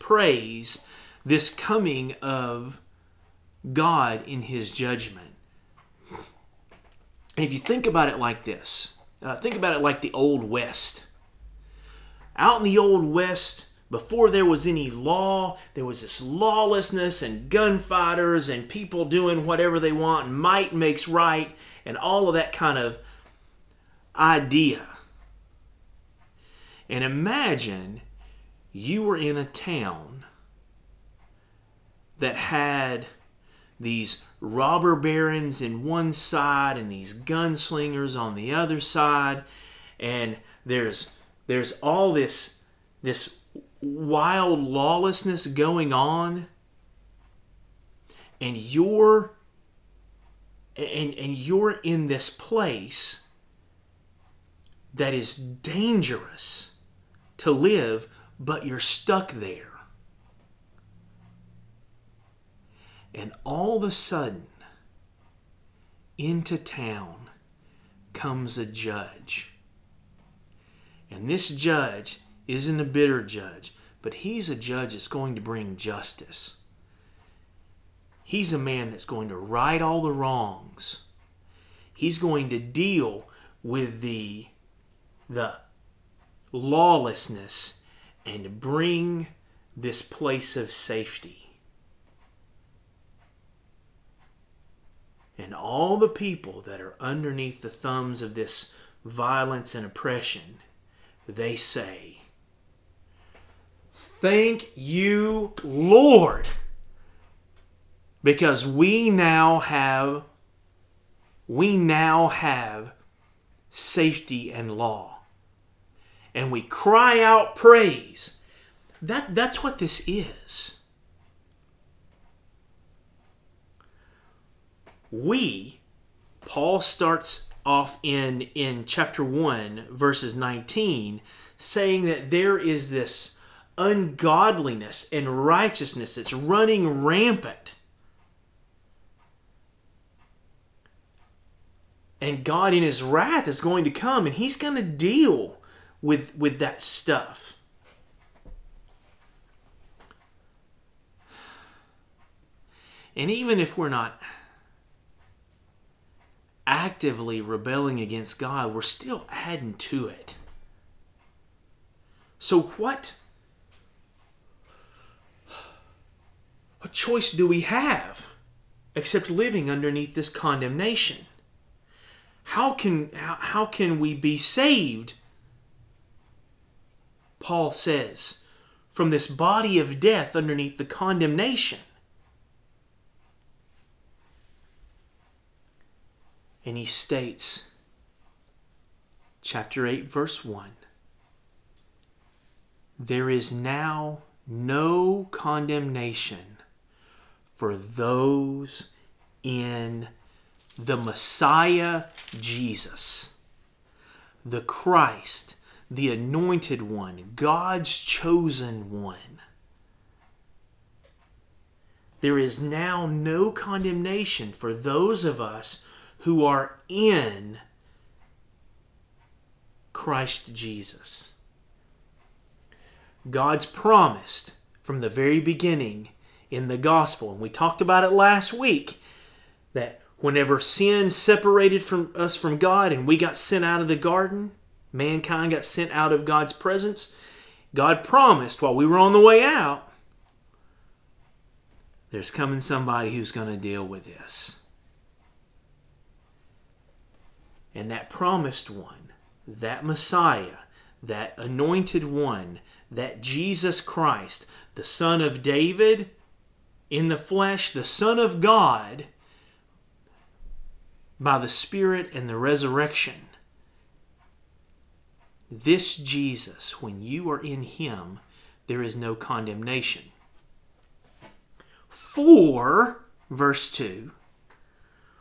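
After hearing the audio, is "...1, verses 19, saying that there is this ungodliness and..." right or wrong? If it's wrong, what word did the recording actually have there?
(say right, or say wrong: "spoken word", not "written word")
right.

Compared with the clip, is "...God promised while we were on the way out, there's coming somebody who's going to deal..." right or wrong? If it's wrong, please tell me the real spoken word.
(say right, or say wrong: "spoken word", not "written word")
right.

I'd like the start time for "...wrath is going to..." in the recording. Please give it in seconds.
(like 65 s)
143 s.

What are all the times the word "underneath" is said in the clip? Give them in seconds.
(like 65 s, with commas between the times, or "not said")
96 s, 169 s, 180 s.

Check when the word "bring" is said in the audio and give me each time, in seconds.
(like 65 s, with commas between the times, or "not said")
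75 s, 88 s.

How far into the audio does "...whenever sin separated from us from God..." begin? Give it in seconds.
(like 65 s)
230 s.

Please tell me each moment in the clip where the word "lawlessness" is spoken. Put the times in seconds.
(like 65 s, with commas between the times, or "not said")
16 s, 44 s, 86 s.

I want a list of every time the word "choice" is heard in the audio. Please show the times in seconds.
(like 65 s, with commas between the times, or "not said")
166 s.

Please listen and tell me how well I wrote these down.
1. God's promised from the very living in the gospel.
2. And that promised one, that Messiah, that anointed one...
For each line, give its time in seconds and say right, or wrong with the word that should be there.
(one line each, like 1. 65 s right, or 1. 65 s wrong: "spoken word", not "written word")
1. 223 s wrong: "beginning", not "living"
2. 247 s right.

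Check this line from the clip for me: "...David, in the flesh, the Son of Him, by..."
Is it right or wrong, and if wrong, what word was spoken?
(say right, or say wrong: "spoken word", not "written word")
wrong: "God", not "Him".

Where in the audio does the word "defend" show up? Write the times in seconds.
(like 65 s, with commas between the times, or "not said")
not said.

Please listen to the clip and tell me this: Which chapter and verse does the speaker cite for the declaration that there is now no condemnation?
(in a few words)
Chapter 8, verse 1.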